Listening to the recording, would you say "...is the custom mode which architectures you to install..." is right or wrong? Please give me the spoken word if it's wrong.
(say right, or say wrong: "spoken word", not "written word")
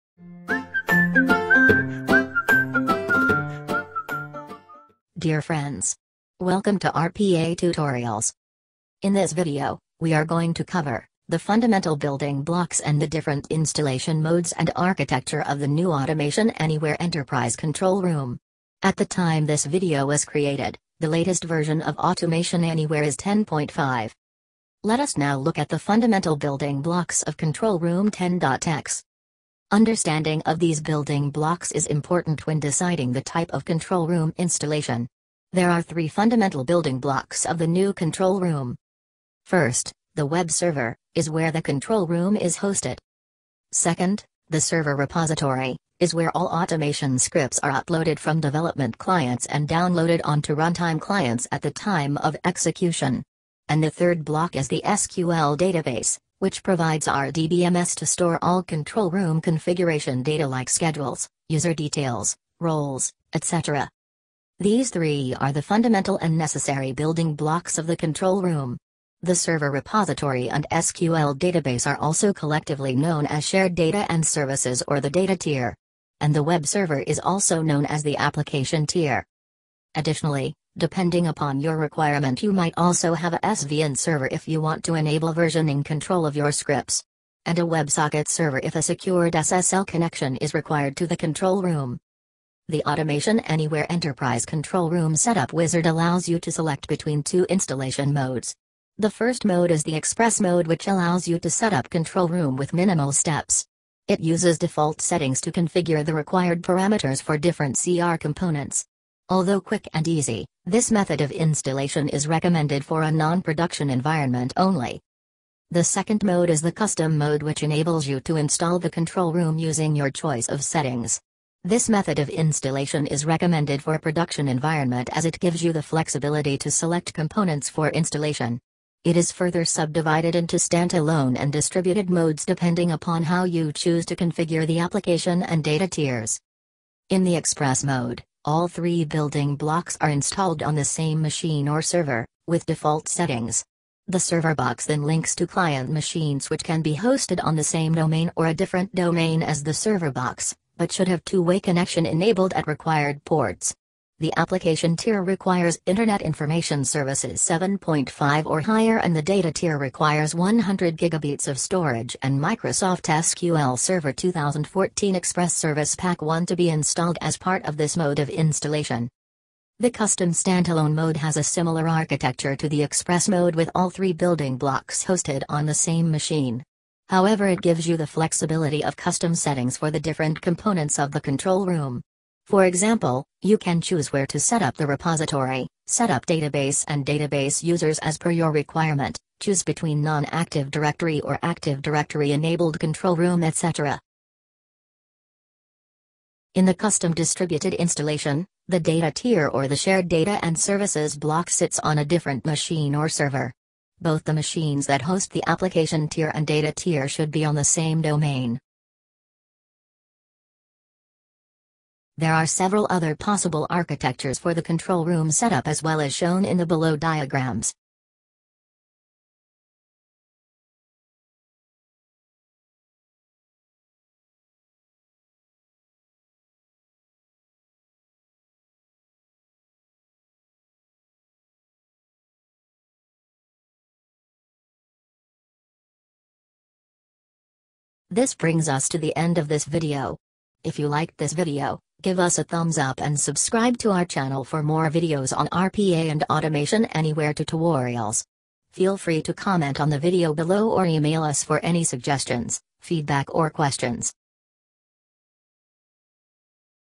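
wrong: "enables", not "architectures".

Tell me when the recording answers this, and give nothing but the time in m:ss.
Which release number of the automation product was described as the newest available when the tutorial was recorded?
0:23.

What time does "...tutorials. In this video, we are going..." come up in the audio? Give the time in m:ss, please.
0:07.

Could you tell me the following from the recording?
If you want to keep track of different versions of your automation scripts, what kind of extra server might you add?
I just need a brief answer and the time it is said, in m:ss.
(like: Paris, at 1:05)
SVN server, at 1:23.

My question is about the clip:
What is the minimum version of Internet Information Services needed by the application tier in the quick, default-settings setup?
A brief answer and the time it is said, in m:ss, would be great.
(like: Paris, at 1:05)
7.5, at 2:37.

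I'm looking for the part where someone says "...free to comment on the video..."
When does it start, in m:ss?
4:08.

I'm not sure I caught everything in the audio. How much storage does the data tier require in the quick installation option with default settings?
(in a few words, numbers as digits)
100 gigabits.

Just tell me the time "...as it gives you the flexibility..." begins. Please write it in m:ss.
2:05.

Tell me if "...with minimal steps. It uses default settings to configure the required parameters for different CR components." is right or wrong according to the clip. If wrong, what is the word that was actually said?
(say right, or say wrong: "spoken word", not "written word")
right.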